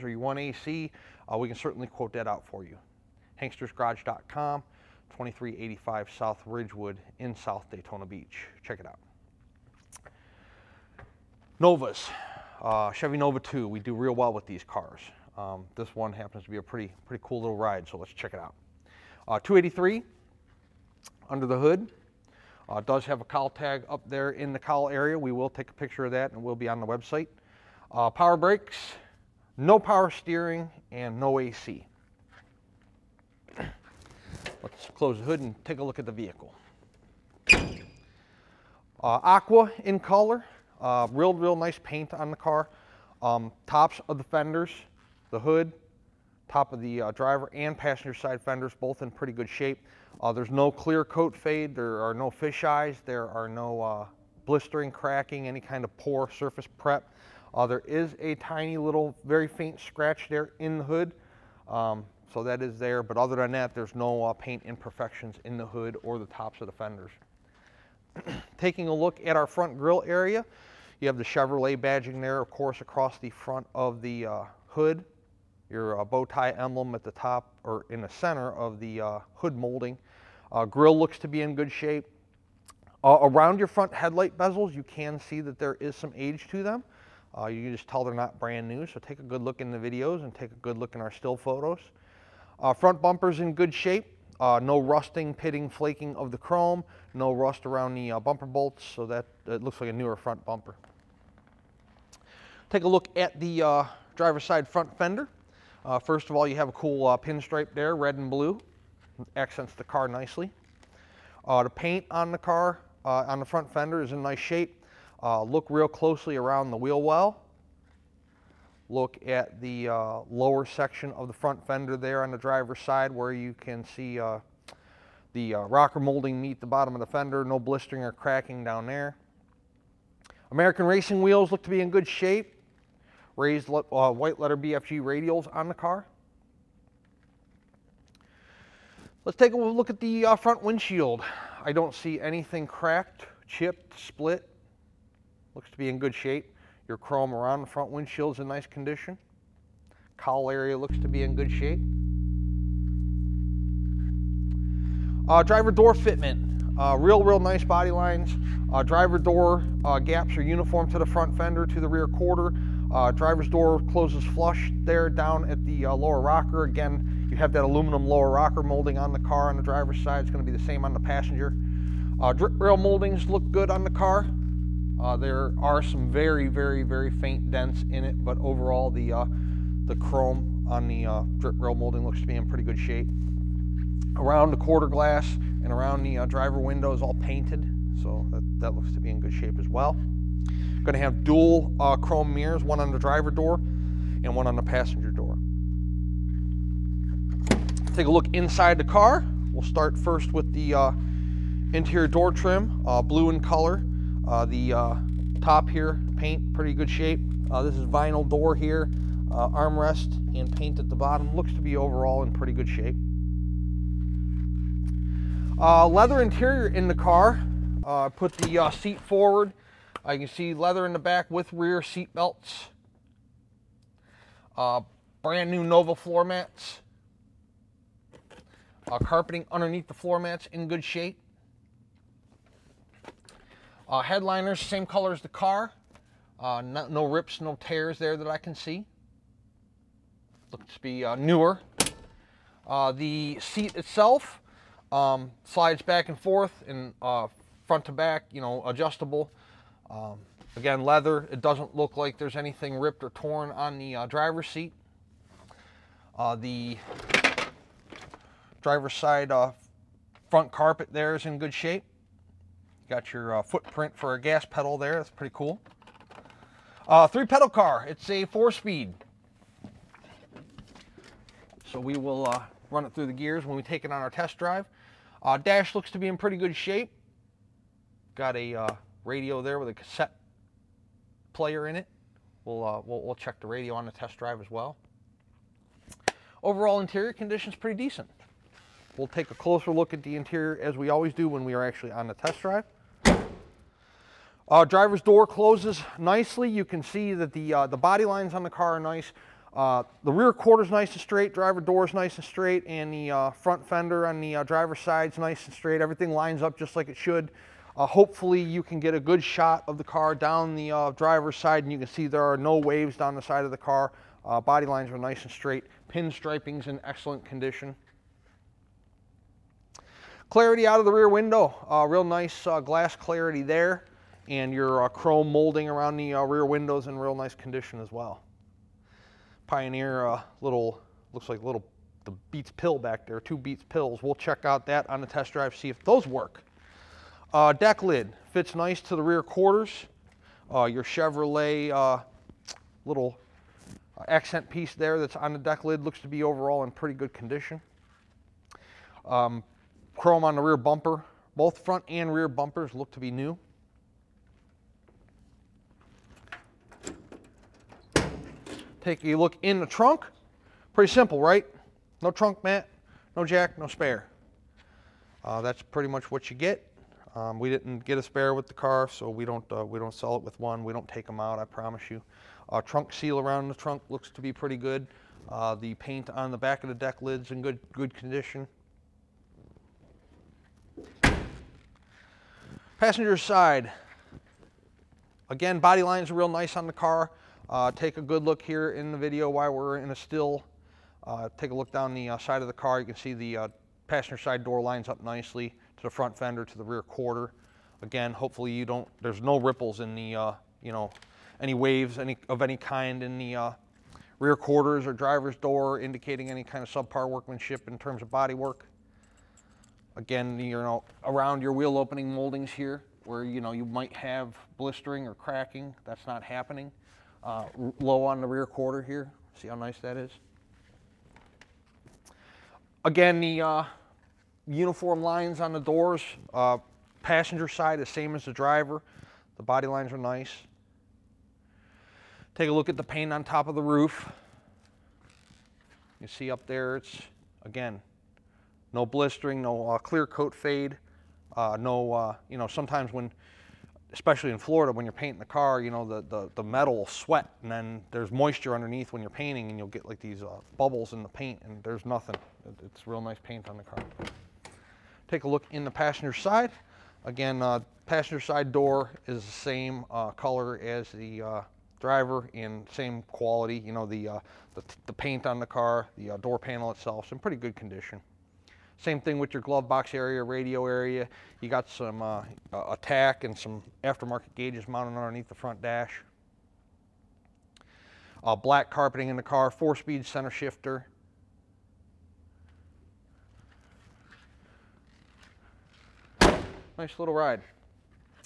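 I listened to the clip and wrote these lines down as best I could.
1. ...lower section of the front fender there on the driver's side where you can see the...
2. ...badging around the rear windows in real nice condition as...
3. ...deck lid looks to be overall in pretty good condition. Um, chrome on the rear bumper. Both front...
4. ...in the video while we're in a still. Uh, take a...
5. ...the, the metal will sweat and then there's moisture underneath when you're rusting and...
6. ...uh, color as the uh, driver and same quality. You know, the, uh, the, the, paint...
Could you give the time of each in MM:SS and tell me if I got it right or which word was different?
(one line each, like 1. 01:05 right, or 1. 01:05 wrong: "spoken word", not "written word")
1. 02:00 right
2. 05:25 wrong: "molding", not "badging"
3. 05:45 right
4. 06:28 right
5. 07:26 wrong: "painting", not "rusting"
6. 07:39 right.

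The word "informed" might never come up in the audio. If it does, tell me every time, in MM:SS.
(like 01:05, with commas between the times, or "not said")
not said.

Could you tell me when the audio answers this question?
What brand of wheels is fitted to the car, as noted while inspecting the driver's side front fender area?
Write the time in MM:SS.
02:10.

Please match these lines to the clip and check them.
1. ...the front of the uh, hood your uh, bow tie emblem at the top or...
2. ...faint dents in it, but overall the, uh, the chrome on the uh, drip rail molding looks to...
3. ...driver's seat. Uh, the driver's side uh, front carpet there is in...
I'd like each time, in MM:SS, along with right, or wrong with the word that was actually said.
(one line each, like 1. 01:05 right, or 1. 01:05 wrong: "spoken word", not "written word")
1. 01:13 right
2. 02:57 right
3. 04:14 right.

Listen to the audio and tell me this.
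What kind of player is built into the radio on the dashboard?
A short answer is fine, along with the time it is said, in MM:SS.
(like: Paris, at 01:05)
cassette player, at 04:39.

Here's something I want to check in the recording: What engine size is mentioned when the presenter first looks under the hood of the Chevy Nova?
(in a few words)
283.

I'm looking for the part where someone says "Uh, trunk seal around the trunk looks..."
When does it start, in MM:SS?
06:12.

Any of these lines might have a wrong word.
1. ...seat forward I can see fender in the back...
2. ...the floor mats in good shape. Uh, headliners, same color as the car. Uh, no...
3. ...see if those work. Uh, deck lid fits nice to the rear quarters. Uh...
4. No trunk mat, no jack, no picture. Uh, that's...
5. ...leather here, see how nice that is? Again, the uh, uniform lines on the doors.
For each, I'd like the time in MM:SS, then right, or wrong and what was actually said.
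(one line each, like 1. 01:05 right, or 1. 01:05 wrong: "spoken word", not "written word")
1. 03:38 wrong: "leather", not "fender"
2. 03:49 right
3. 05:35 right
4. 06:02 wrong: "spare", not "picture"
5. 06:58 wrong: "quarter", not "leather".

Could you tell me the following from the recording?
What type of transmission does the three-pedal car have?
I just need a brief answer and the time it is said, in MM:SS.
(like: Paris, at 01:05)
four speed, at 04:28.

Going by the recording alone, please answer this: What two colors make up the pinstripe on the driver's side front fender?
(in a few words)
red and blue.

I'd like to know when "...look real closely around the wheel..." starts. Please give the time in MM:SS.
01:55.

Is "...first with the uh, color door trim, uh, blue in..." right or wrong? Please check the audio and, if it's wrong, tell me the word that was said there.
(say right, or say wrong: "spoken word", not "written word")
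wrong: "interior", not "color".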